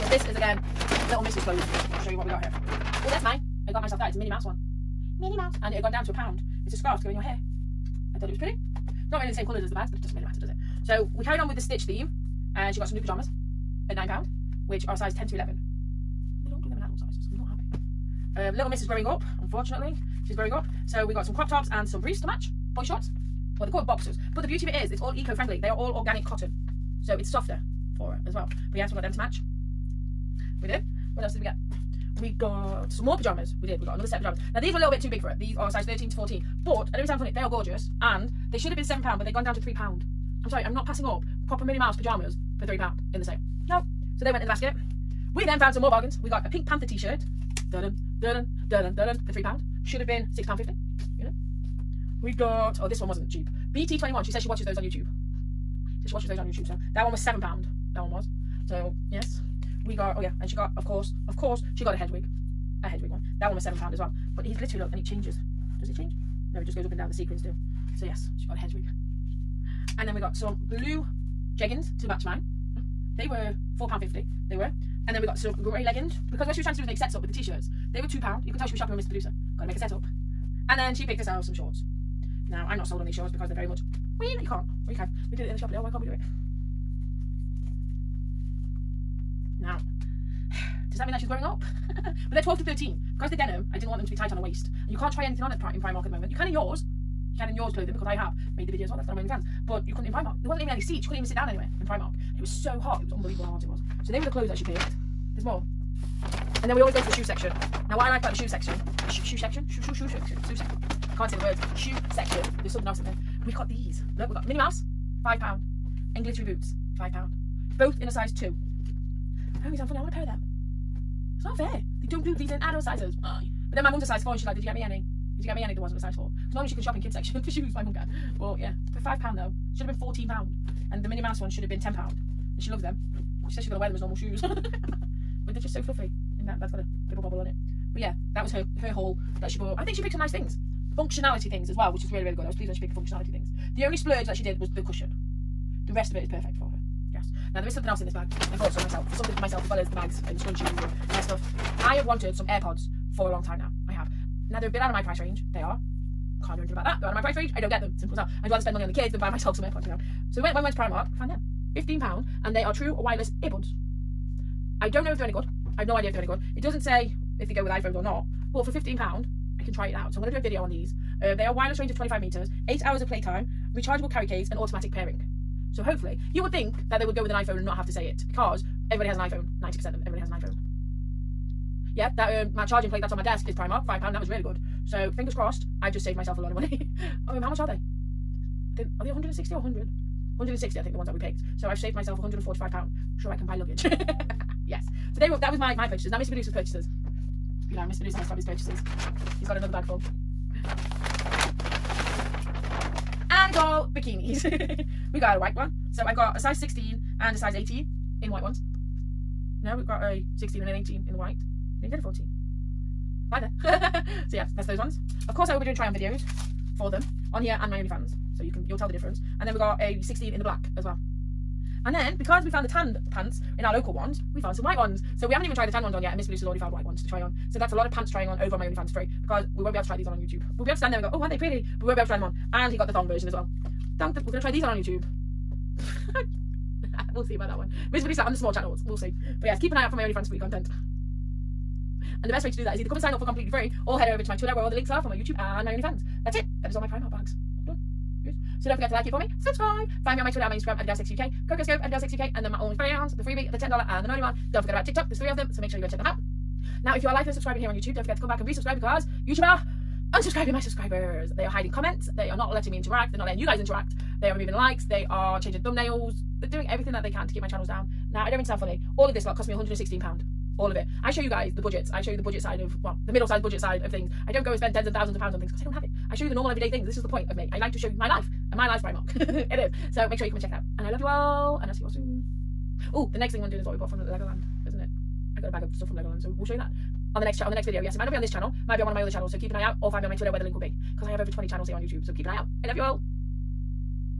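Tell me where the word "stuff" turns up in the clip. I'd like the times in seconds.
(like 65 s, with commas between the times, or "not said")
151 s, 285 s.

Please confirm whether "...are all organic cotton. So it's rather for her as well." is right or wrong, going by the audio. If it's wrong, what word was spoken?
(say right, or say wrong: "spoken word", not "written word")
wrong: "softer", not "rather".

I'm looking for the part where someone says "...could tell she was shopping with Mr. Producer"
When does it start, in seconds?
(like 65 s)
78 s.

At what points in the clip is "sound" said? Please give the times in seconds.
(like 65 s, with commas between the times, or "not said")
37 s, 119 s, 268 s.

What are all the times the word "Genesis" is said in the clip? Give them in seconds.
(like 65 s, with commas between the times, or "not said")
not said.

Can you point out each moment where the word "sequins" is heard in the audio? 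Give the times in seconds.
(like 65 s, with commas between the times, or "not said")
67 s.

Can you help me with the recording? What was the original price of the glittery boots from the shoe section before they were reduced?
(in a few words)
£14.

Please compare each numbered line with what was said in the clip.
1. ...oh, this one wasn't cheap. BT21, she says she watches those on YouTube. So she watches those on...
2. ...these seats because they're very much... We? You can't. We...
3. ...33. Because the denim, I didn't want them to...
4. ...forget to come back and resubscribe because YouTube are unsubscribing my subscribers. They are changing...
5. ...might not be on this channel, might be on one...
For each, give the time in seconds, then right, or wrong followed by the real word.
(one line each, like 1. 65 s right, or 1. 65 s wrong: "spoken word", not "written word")
1. 52 s right
2. 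83 s wrong: "shorts", not "seats"
3. 92 s wrong: "13", not "33"
4. 258 s wrong: "hiding", not "changing"
5. 287 s right.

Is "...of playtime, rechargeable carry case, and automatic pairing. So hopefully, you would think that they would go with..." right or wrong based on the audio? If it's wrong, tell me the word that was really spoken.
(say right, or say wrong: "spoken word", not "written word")
right.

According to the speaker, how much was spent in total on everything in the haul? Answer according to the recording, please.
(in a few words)
£116.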